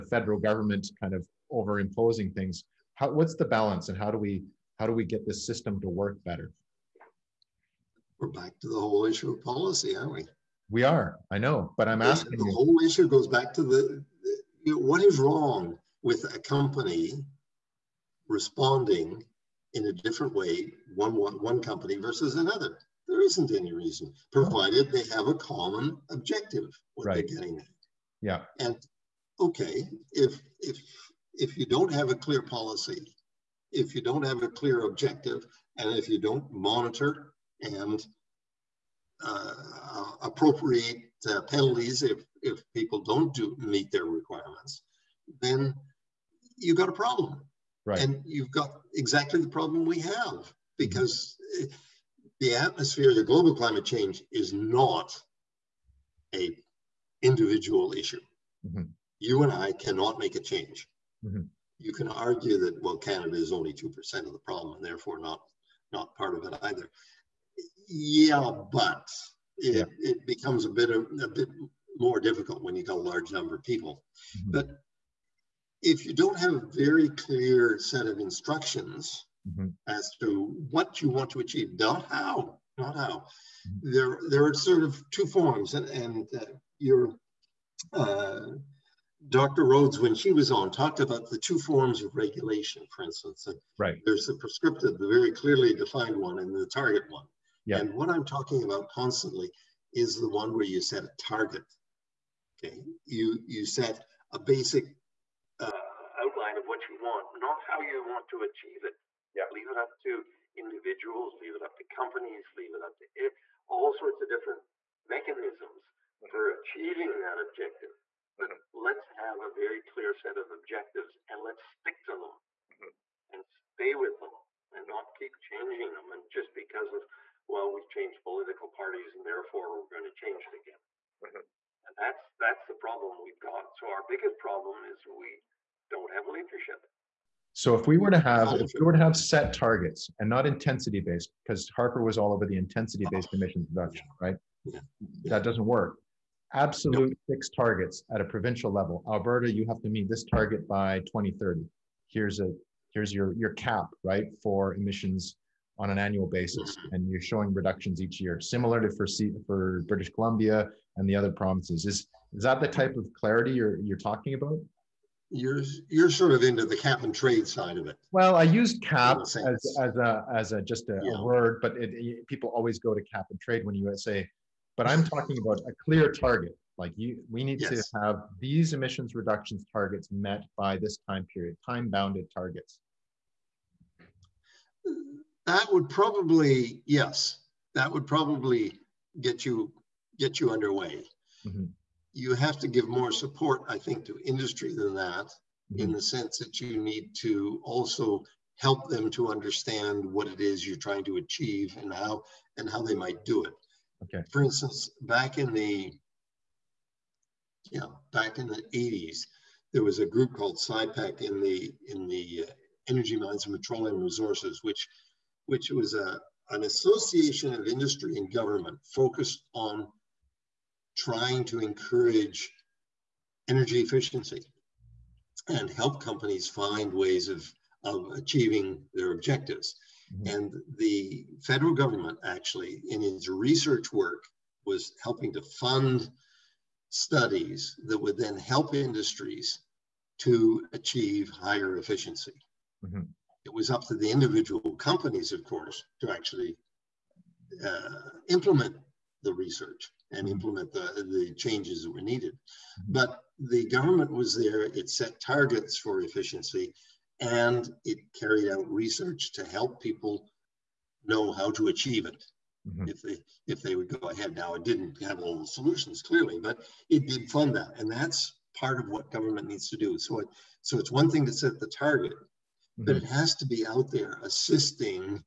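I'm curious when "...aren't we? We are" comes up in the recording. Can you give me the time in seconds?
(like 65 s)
9 s.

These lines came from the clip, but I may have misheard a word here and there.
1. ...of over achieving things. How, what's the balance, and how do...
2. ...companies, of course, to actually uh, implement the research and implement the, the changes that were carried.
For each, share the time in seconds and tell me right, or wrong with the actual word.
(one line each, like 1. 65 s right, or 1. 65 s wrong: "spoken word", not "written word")
1. 1 s wrong: "imposing", not "achieving"
2. 244 s wrong: "needed", not "carried".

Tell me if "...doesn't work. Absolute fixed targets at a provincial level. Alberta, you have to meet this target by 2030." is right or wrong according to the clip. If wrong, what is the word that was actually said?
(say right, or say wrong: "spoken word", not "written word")
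right.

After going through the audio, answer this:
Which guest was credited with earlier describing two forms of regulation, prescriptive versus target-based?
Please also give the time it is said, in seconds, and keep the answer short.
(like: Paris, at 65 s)
Dr. Rhodes, at 89 s.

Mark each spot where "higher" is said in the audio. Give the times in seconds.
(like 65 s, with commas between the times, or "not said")
241 s.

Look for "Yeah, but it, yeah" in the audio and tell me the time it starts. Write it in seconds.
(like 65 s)
67 s.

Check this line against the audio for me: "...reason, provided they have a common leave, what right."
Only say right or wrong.
wrong.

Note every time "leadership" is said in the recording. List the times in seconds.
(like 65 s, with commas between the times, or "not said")
136 s.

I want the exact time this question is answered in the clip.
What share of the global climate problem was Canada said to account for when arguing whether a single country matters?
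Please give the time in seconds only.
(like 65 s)
63 s.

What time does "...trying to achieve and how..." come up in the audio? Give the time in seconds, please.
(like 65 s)
200 s.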